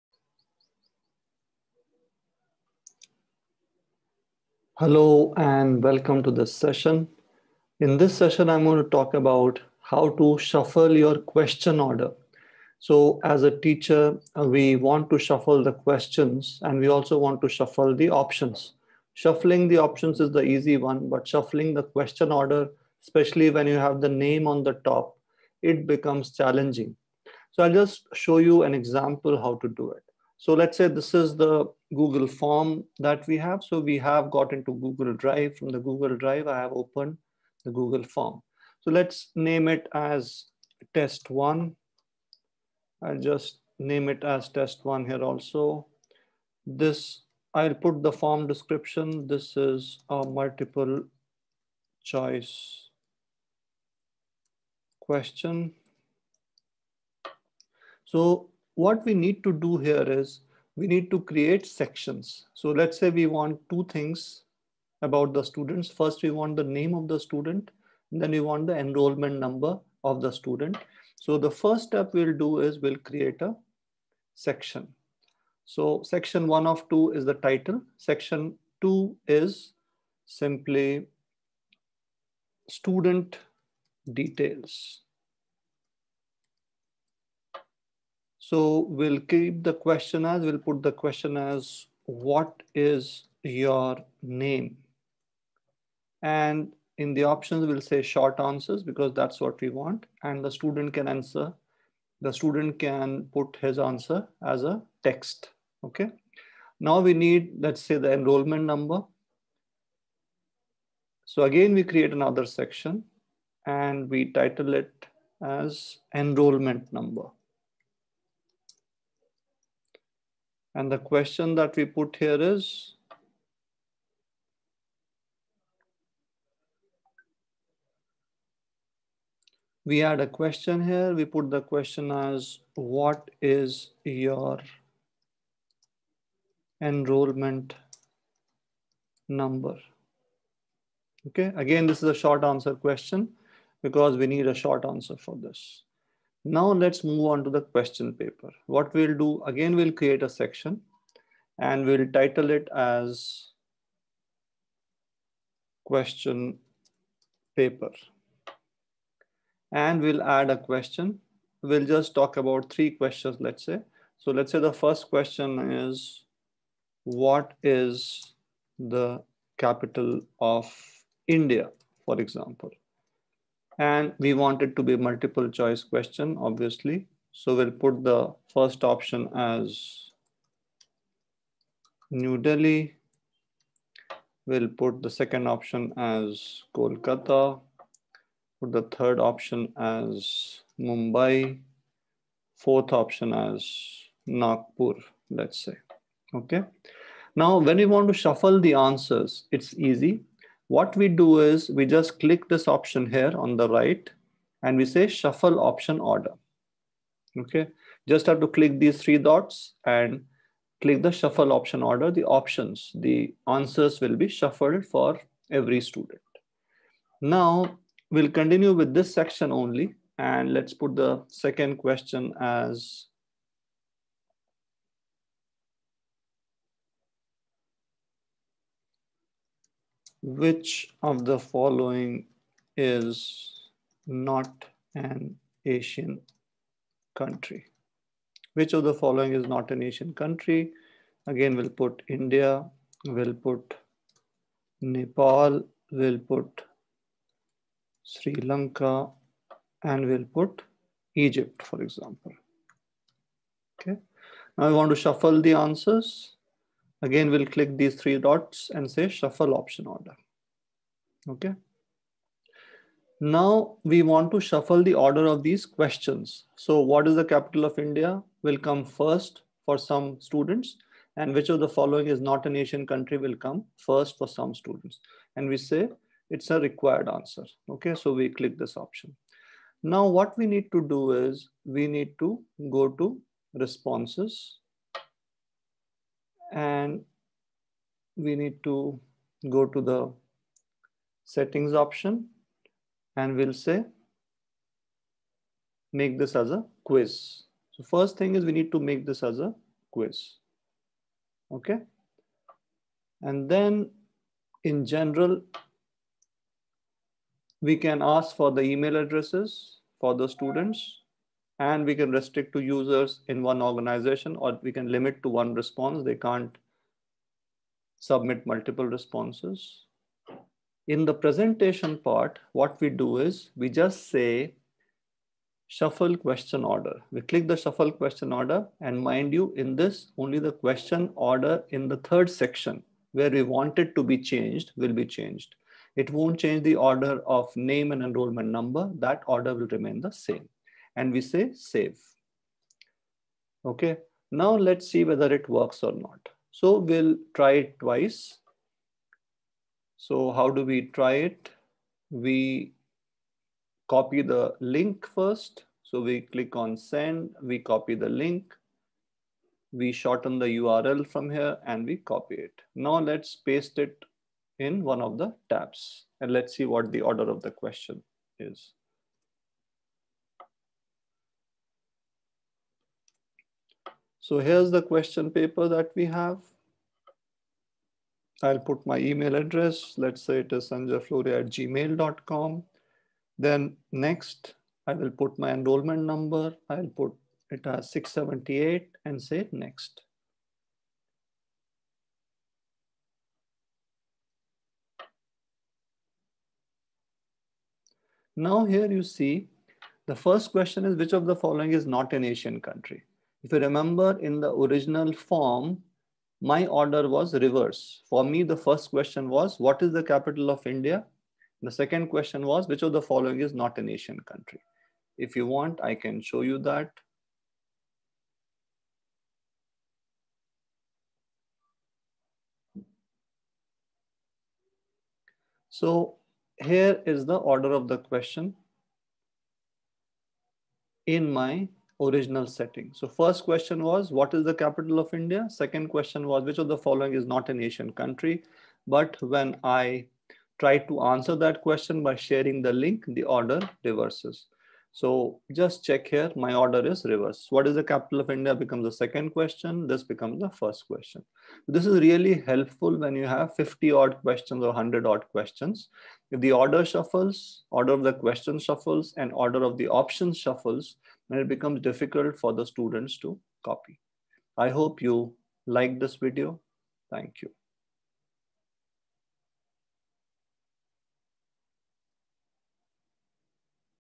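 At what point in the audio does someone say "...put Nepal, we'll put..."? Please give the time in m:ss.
4:03.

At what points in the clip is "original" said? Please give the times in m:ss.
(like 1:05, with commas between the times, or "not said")
6:44, 7:12.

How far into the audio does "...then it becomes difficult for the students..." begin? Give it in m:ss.
7:41.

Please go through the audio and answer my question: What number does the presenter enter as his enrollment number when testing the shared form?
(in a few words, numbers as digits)
678.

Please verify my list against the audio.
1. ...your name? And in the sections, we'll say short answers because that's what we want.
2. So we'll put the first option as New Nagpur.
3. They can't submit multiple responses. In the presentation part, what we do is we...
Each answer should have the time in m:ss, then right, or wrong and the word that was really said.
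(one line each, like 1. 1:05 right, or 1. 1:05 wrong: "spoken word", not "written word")
1. 1:33 wrong: "options", not "sections"
2. 2:57 wrong: "Delhi", not "Nagpur"
3. 5:16 right.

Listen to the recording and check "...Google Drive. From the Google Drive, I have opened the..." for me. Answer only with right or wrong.
right.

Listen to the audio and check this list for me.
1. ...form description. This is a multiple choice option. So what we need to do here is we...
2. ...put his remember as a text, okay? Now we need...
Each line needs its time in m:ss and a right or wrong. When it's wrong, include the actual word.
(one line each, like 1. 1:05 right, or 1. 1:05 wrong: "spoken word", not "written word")
1. 0:48 wrong: "question", not "option"
2. 1:43 wrong: "answer", not "remember".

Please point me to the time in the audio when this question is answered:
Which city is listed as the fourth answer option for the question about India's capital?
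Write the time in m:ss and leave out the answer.
3:14.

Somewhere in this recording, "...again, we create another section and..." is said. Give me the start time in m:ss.
1:51.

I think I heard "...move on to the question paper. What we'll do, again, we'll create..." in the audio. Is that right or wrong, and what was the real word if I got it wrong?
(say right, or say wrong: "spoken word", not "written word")
right.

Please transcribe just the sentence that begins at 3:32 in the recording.
The options, the answers will be shuffled for every student.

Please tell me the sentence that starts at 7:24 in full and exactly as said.
So just check here, my order is reverse.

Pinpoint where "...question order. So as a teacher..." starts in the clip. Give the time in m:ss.
0:11.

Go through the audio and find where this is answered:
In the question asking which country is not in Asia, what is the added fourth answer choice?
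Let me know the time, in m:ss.
4:11.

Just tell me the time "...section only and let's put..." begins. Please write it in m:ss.
3:39.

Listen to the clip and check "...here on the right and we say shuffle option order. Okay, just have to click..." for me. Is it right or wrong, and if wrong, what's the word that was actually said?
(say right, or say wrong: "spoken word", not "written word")
right.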